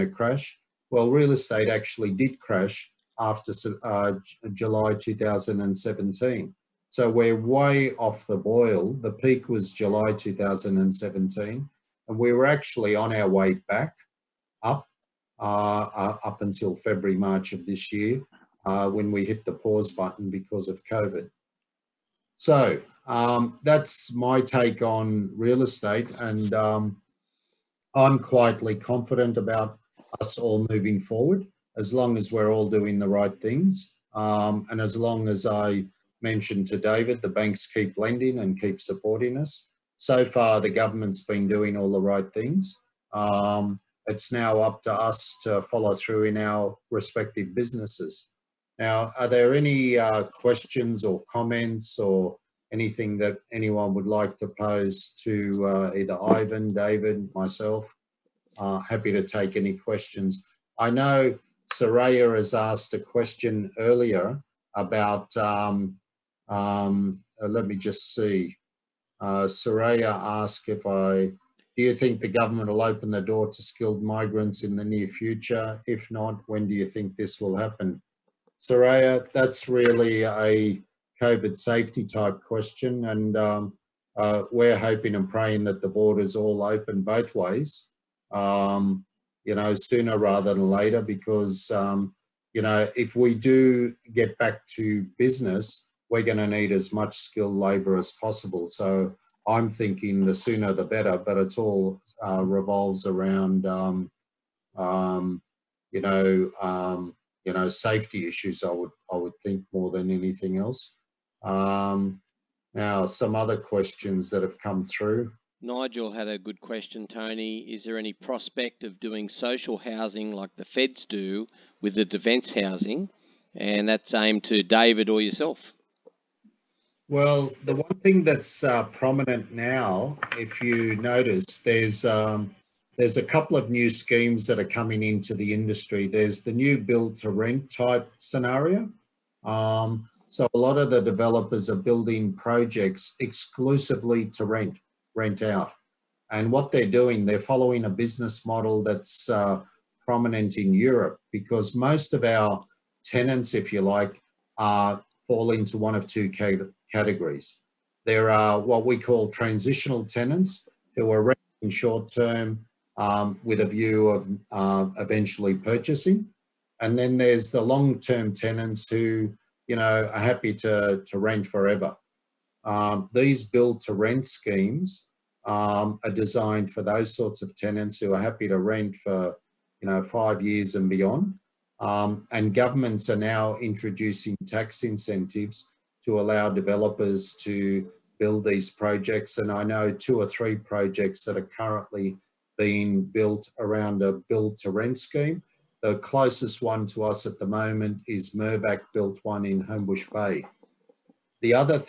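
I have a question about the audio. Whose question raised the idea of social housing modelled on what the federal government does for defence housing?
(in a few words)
Nigel.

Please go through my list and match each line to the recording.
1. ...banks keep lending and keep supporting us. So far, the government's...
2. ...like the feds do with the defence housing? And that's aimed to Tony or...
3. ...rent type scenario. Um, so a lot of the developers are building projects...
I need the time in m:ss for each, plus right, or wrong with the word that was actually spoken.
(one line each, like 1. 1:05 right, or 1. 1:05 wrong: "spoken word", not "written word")
1. 0:37 right
2. 2:00 wrong: "David", not "Tony"
3. 2:17 right.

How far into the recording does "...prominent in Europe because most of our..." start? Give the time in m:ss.
2:30.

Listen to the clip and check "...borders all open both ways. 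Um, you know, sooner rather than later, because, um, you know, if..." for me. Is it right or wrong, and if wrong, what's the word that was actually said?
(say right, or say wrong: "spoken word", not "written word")
right.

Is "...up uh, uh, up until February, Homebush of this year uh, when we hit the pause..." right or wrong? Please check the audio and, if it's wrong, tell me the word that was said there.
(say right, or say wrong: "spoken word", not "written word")
wrong: "March", not "Homebush".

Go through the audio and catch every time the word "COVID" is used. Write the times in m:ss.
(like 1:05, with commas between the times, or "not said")
0:20, 1:21.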